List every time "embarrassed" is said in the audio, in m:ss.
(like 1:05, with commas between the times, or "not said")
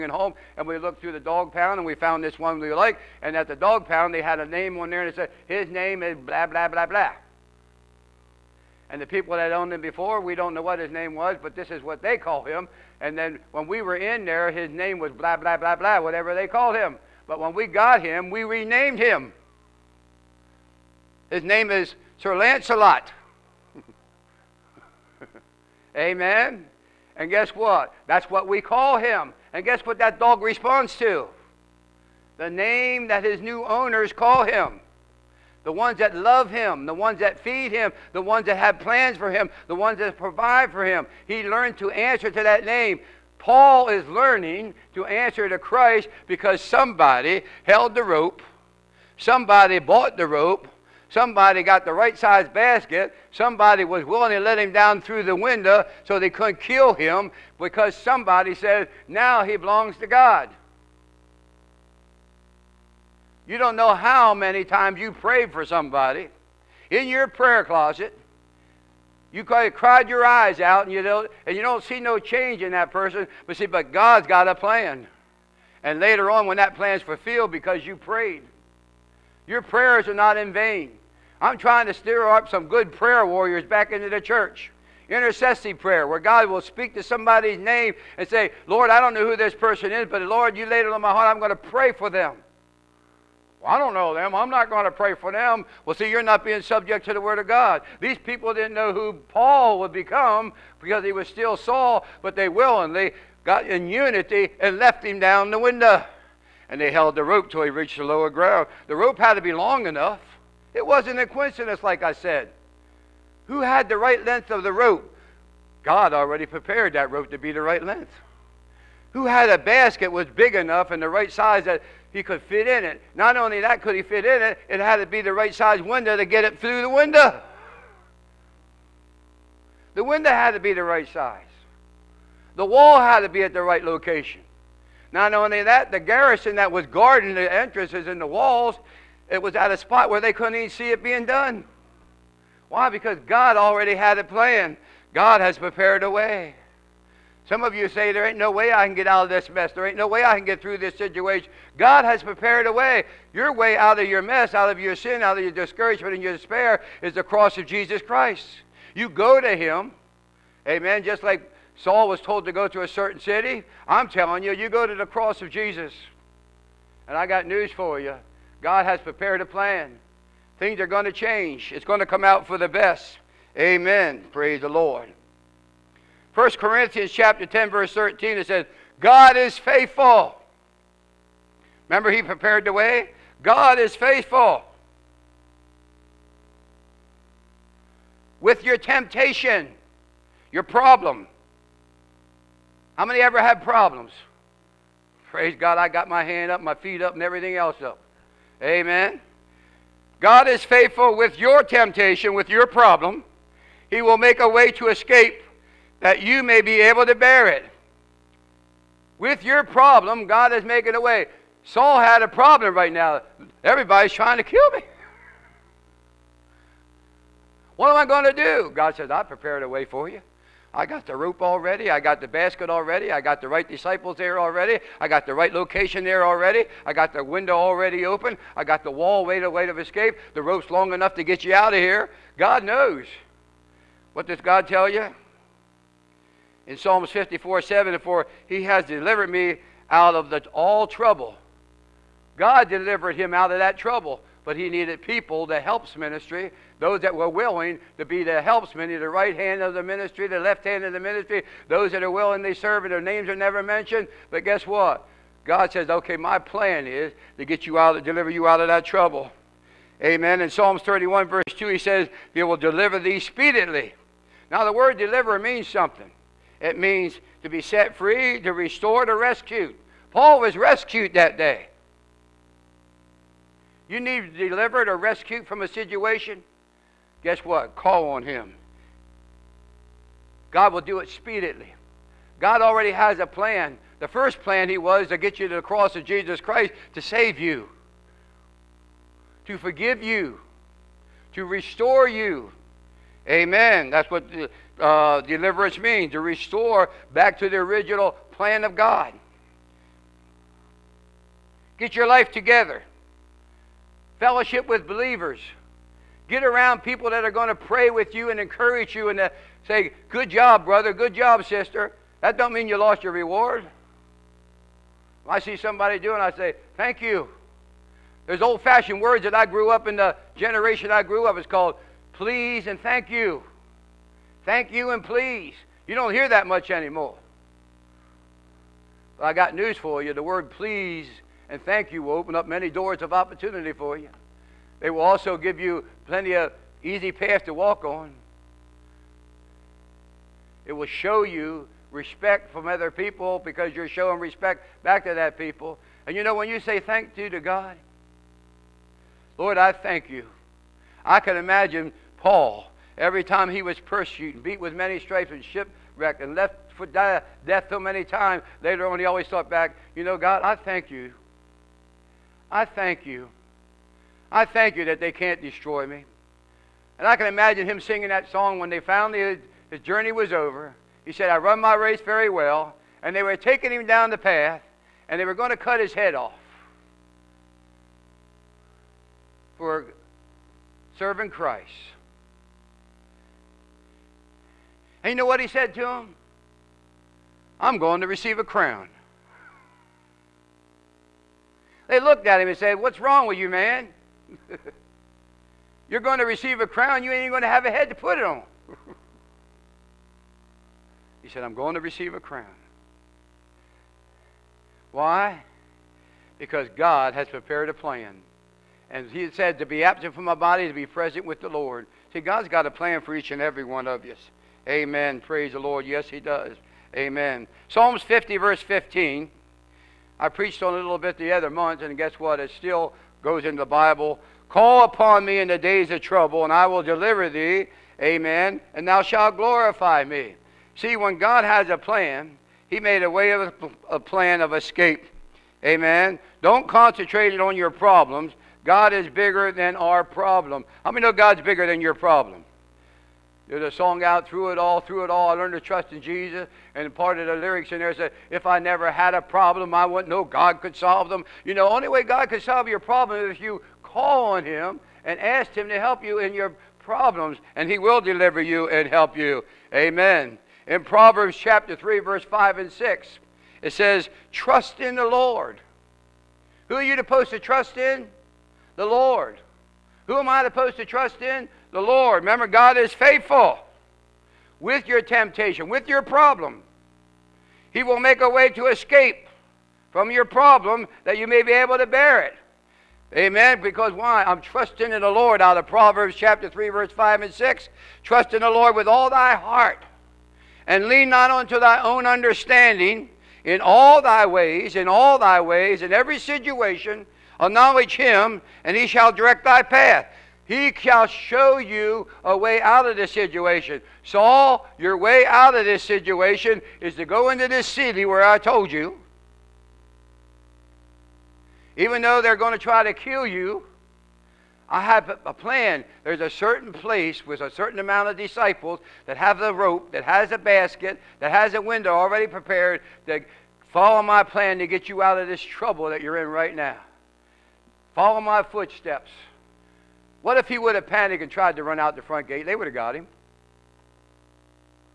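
not said.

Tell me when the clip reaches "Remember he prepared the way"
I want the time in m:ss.
3:01.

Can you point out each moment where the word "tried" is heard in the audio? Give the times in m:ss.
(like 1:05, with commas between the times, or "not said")
8:51.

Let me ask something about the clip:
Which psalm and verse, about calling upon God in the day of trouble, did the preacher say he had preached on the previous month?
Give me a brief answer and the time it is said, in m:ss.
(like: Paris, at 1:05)
Psalms 50:15, at 6:57.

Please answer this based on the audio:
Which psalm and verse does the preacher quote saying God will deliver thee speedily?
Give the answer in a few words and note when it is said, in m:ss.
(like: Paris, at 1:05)
Psalms 31:2, at 4:20.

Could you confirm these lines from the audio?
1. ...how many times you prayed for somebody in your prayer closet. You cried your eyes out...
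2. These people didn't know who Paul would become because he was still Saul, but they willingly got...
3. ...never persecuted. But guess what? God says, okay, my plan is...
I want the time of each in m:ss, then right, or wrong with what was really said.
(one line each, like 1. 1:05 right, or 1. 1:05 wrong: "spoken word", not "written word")
1. 1:03 right
2. 1:37 right
3. 4:13 wrong: "mentioned", not "persecuted".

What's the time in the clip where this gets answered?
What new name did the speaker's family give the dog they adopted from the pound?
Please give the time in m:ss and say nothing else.
0:22.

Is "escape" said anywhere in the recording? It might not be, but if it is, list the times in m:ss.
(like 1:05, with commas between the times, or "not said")
3:24, 3:49, 7:14, 7:58.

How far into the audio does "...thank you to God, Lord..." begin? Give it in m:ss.
5:46.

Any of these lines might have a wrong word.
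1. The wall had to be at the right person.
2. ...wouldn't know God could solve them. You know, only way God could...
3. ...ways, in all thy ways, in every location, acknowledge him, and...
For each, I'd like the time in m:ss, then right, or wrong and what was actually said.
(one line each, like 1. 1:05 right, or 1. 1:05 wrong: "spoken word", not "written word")
1. 2:12 wrong: "location", not "person"
2. 7:29 right
3. 8:14 wrong: "situation", not "location".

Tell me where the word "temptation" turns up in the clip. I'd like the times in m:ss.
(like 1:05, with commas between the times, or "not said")
3:08, 3:21, 7:55.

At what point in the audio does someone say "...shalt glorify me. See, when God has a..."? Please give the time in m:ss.
7:09.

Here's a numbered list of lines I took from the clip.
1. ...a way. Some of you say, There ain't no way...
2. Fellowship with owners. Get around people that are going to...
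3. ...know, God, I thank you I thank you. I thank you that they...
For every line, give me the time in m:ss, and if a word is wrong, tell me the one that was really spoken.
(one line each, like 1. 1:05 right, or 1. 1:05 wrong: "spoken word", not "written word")
1. 2:26 right
2. 5:04 wrong: "believers", not "owners"
3. 6:00 right.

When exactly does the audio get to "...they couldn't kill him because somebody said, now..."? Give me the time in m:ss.
0:56.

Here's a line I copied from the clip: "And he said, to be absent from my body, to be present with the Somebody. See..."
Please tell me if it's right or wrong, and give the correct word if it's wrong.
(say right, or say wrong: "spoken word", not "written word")
wrong: "Lord", not "Somebody".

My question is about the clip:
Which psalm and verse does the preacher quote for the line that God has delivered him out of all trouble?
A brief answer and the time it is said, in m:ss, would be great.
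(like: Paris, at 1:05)
Psalms 54:7, at 3:56.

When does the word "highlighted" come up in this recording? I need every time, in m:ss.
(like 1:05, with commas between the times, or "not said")
not said.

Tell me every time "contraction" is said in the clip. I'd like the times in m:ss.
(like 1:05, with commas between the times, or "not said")
not said.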